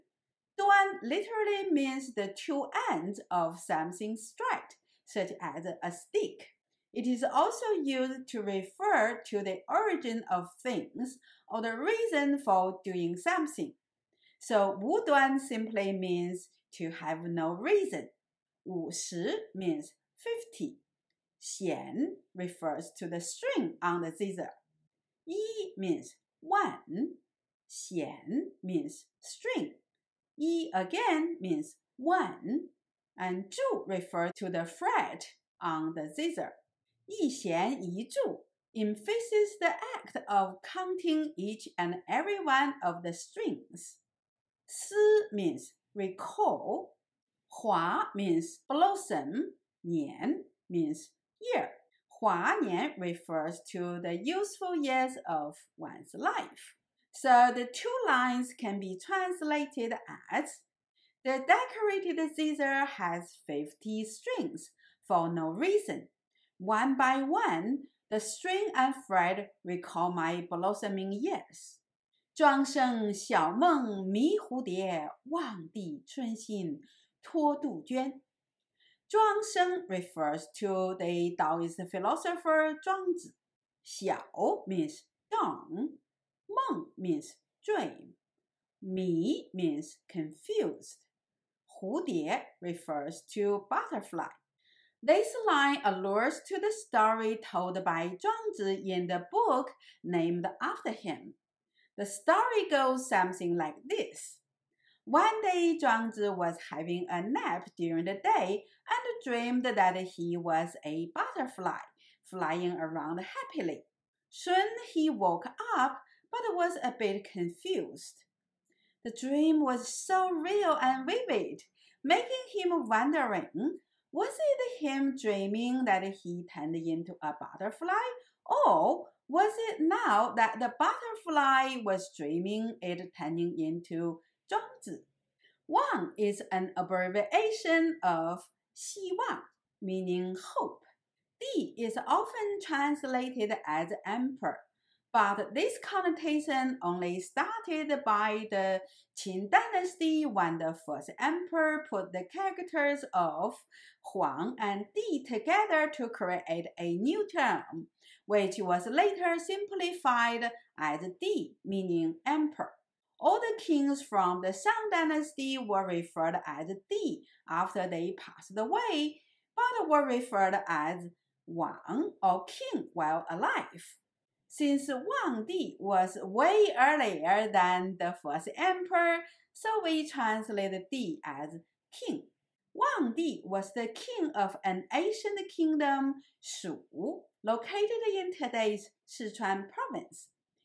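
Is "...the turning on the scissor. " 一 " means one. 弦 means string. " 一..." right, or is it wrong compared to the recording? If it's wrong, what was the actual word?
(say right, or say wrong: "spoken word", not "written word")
wrong: "string", not "turning".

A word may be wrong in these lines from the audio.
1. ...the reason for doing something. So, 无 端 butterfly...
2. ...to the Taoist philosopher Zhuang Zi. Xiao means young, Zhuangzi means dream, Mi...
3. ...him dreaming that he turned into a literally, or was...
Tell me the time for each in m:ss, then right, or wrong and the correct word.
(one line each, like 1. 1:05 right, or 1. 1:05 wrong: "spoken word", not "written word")
1. 0:11 wrong: "simply", not "butterfly"
2. 1:20 wrong: "Meng", not "Zhuangzi"
3. 2:04 wrong: "butterfly", not "literally".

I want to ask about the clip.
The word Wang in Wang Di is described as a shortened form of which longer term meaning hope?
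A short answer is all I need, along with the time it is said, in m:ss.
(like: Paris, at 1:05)
Xi Wang, at 2:18.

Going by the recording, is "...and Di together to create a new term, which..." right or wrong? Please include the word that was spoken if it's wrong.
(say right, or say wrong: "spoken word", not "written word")
right.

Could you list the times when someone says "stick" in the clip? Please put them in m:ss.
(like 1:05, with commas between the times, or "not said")
0:05.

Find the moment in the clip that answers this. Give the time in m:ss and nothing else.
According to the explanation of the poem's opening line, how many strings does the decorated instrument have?
0:18.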